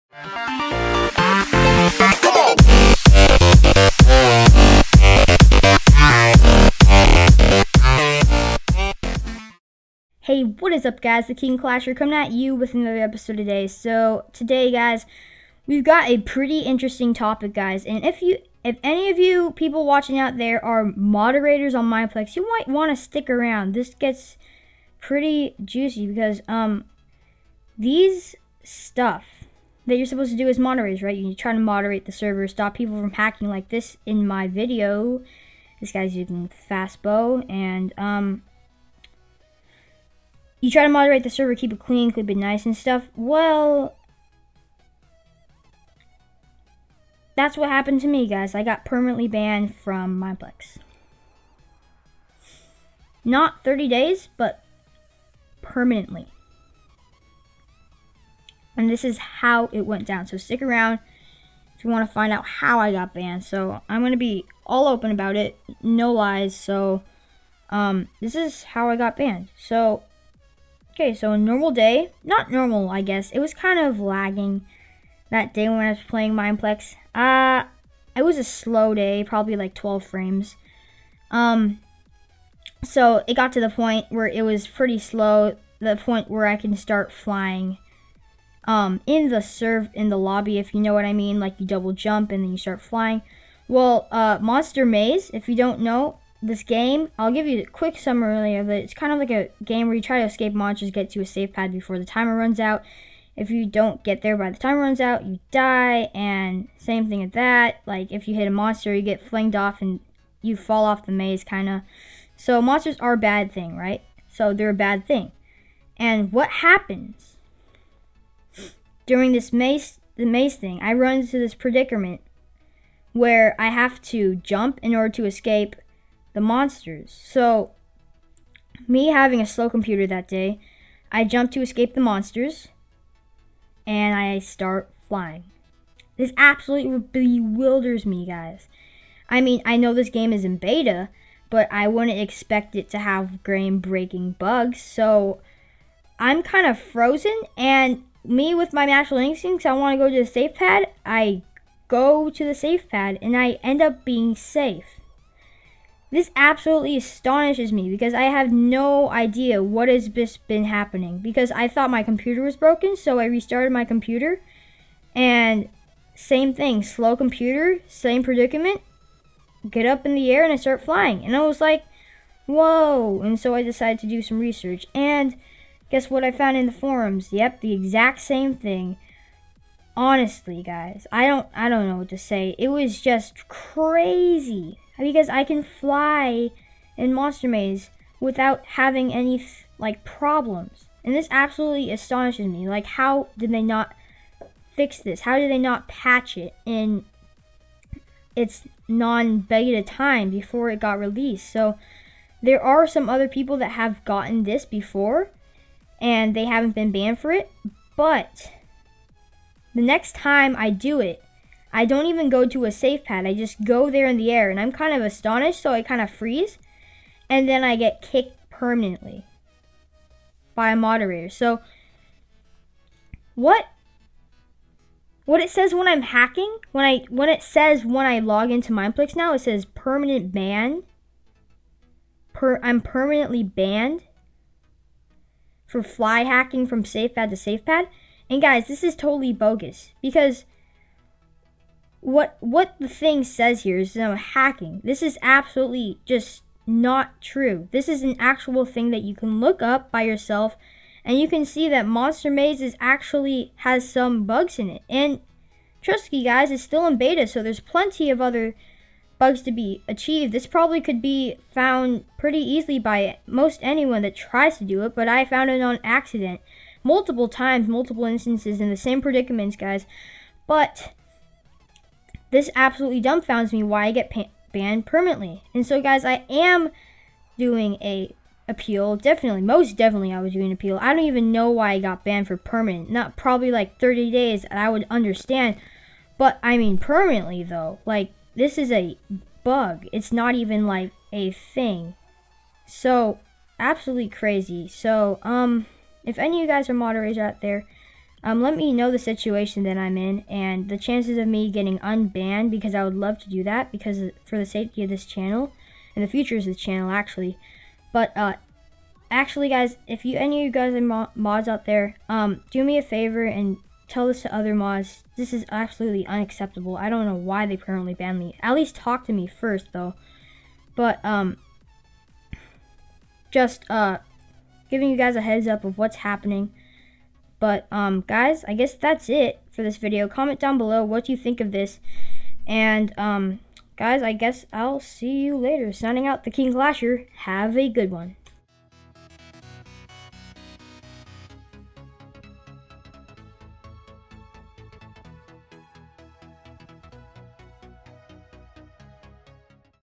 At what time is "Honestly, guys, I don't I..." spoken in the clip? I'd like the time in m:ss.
2:59.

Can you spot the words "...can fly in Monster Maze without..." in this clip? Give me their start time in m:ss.
3:05.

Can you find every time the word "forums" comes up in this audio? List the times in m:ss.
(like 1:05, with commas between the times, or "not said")
2:56.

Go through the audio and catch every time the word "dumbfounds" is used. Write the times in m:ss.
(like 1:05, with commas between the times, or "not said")
4:33.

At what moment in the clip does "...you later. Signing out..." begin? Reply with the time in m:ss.
5:35.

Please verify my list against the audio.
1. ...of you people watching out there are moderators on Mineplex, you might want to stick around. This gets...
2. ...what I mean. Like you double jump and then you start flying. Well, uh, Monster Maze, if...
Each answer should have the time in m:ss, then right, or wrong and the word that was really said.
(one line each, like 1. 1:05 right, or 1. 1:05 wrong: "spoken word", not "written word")
1. 0:19 right
2. 1:30 right.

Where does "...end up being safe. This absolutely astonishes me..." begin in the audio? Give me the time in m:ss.
2:33.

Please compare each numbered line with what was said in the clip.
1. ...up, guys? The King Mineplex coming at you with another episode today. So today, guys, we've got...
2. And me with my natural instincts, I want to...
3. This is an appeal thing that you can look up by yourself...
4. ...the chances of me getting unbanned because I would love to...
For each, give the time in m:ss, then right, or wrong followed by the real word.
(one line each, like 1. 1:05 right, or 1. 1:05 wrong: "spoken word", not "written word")
1. 0:10 wrong: "Clasher", not "Mineplex"
2. 2:27 right
3. 4:07 wrong: "actual", not "appeal"
4. 5:00 right.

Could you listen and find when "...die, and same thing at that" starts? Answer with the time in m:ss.
1:45.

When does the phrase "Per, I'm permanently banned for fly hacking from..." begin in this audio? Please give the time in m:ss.
3:52.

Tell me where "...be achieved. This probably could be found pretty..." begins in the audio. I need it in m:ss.
4:19.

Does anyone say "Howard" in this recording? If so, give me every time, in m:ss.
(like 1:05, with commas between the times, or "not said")
not said.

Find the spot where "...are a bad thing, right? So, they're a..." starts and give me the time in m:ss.
1:52.